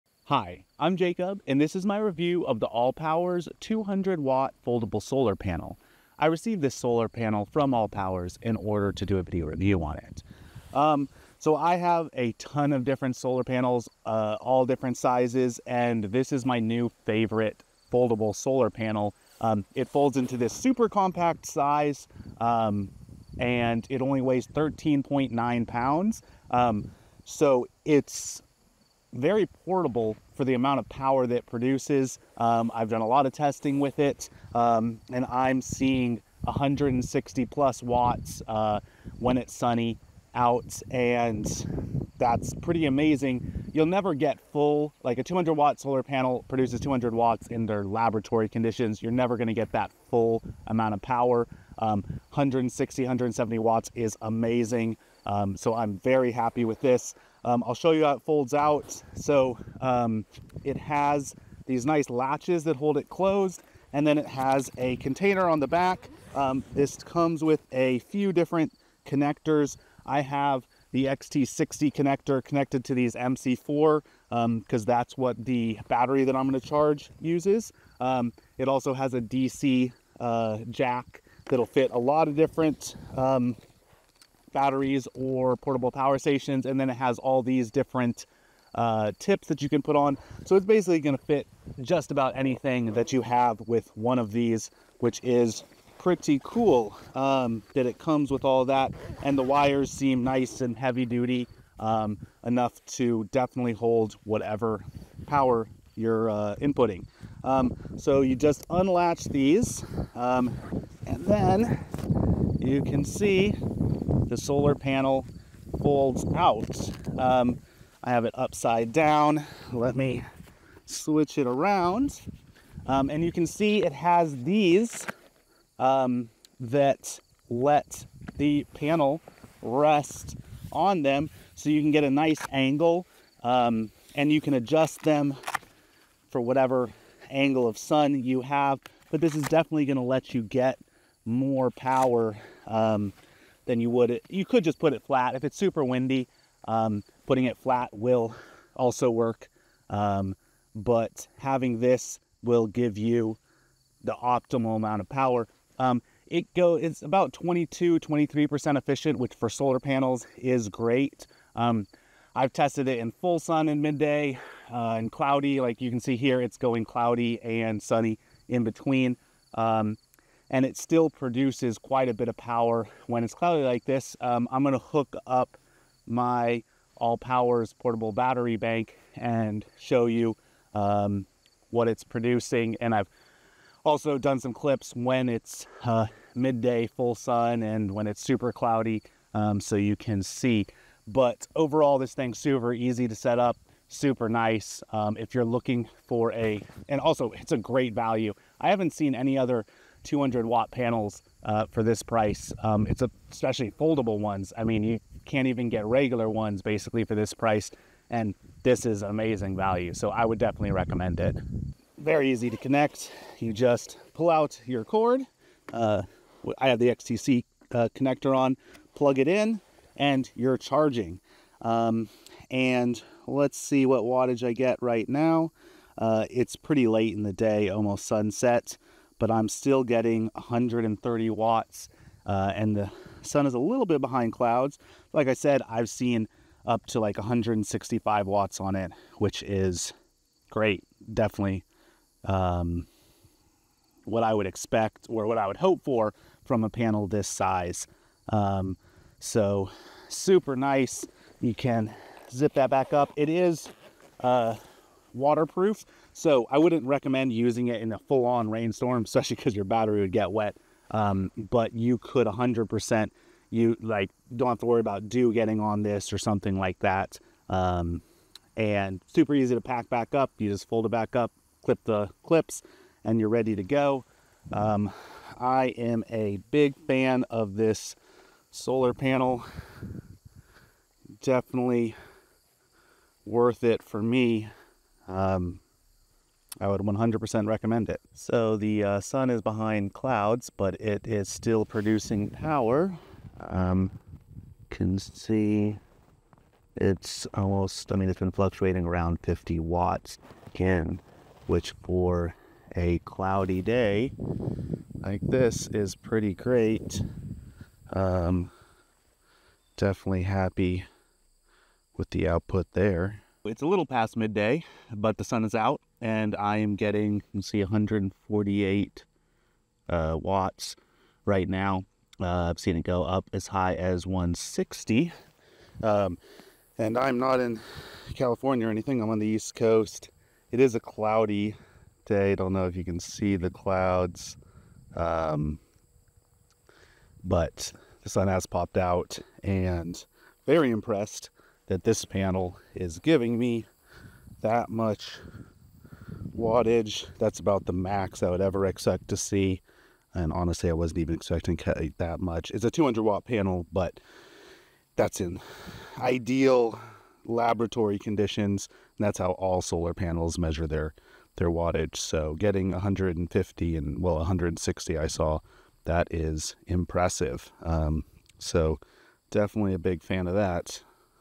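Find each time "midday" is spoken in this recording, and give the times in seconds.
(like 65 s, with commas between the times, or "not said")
163 s, 186 s, 314 s.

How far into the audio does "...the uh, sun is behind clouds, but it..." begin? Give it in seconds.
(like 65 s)
288 s.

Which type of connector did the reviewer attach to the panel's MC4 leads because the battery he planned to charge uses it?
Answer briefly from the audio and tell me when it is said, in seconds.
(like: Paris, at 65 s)
XT60, at 71 s.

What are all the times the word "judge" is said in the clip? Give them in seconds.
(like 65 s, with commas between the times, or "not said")
not said.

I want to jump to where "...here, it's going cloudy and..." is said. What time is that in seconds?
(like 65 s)
166 s.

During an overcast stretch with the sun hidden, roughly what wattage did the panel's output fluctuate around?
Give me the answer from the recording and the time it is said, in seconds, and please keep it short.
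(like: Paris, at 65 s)
50 watts, at 299 s.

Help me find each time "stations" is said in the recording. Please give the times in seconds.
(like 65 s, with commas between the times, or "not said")
86 s.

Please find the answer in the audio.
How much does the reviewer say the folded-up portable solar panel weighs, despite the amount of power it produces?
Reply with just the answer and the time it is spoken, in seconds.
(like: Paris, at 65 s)
13.9 pounds, at 24 s.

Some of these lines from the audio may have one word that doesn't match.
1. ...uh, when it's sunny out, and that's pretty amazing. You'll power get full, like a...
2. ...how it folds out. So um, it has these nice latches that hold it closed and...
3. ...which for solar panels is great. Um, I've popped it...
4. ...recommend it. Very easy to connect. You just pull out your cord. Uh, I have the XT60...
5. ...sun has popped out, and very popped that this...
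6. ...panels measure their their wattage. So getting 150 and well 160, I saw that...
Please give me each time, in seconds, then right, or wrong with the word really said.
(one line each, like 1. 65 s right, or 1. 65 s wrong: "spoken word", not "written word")
1. 38 s wrong: "never", not "power"
2. 58 s right
3. 159 s wrong: "tested", not "popped"
4. 210 s right
5. 338 s wrong: "impressed", not "popped"
6. 359 s right.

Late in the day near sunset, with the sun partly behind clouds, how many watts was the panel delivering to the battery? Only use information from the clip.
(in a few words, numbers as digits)
130 watts.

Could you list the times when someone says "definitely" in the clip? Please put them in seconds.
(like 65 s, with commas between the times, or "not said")
103 s, 139 s, 210 s, 241 s, 281 s, 309 s, 369 s.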